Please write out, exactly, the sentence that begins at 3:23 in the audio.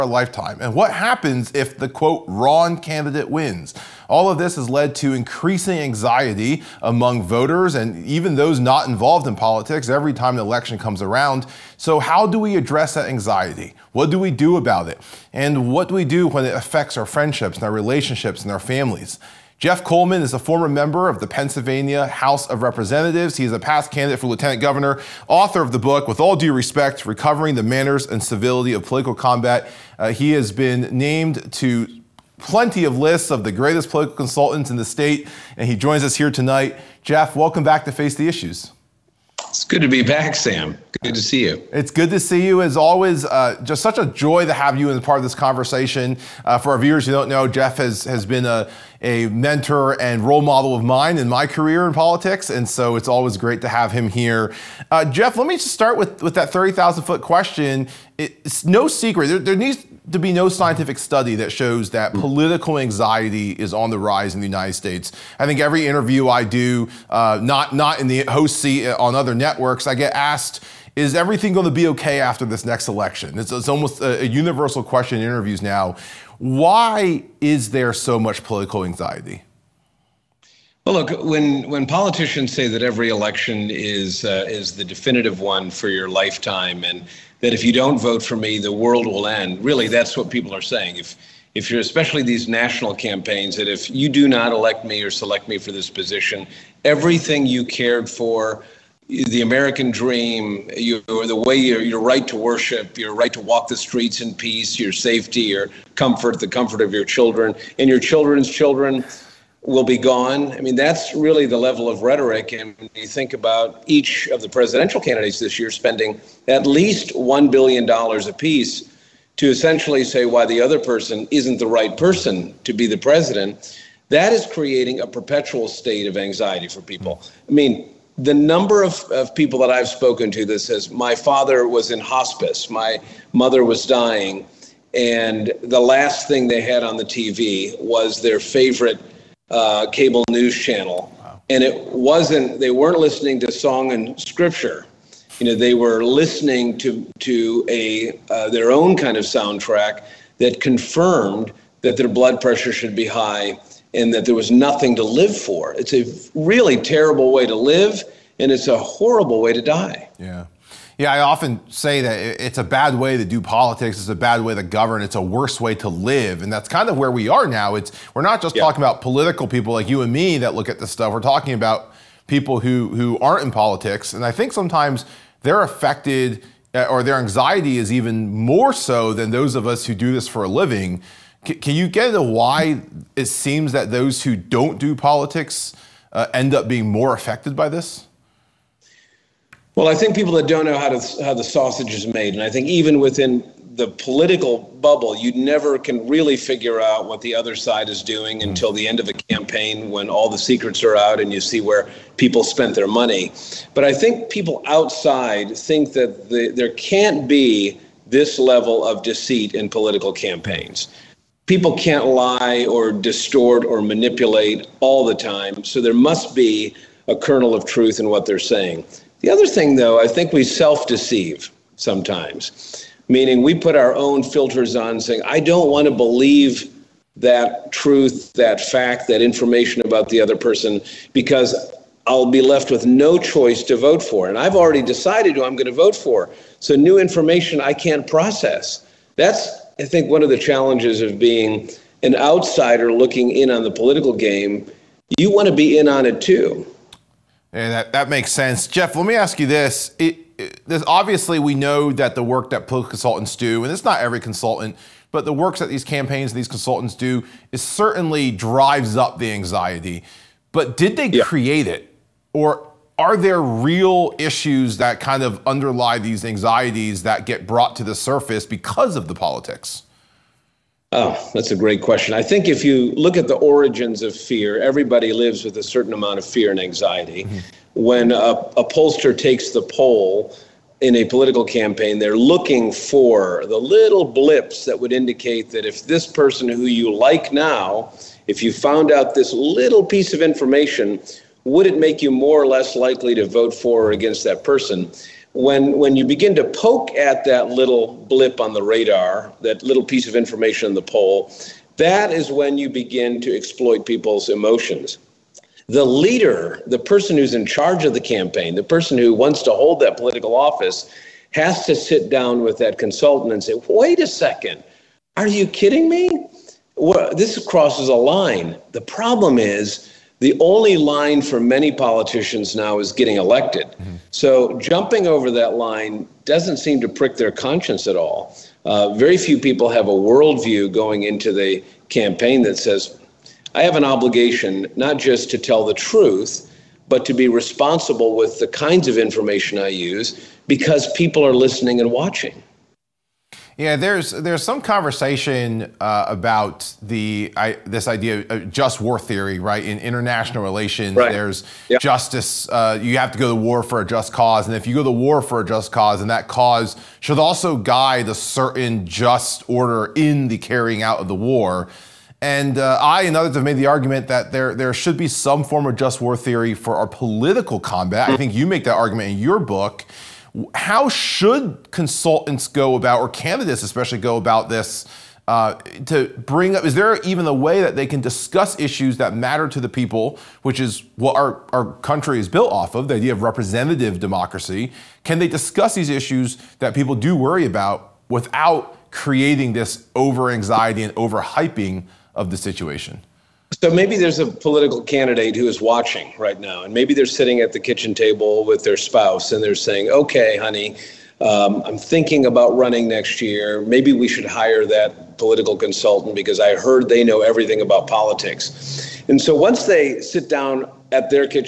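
But I think people outside think that the, there can't be this level of deceit in political campaigns.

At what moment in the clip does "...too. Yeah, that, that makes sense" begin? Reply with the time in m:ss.
4:06.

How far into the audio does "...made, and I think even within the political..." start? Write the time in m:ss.
3:12.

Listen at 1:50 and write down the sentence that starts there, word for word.
I mean, that's really the level of rhetoric.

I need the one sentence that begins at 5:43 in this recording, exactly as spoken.
Yeah, there's there's some conversation uh, about the I, this idea of just war theory, right?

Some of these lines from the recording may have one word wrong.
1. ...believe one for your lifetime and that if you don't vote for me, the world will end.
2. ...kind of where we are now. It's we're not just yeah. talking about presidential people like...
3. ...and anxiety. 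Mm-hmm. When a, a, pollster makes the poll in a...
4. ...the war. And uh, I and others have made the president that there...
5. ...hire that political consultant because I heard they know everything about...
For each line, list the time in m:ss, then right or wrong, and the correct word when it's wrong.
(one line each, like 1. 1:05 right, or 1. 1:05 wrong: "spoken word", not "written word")
1. 1:24 wrong: "definitive", not "believe"
2. 2:46 wrong: "political", not "presidential"
3. 4:36 wrong: "takes", not "makes"
4. 6:01 wrong: "argument", not "president"
5. 6:44 right.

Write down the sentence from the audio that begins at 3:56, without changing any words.
So new information I can't process.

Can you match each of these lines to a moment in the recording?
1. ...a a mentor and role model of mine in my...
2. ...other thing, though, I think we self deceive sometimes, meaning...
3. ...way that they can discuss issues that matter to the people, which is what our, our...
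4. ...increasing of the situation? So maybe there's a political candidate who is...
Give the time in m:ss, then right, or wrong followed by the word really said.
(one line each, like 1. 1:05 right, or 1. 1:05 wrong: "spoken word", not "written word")
1. 0:48 right
2. 3:39 right
3. 6:17 right
4. 6:31 wrong: "hyping", not "increasing".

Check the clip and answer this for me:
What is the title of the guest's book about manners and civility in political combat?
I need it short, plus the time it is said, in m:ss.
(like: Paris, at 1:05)
With All Due Respect, at 0:26.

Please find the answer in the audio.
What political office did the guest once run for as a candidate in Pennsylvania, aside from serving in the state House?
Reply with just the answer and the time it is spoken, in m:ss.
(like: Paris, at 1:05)
lieutenant governor, at 0:24.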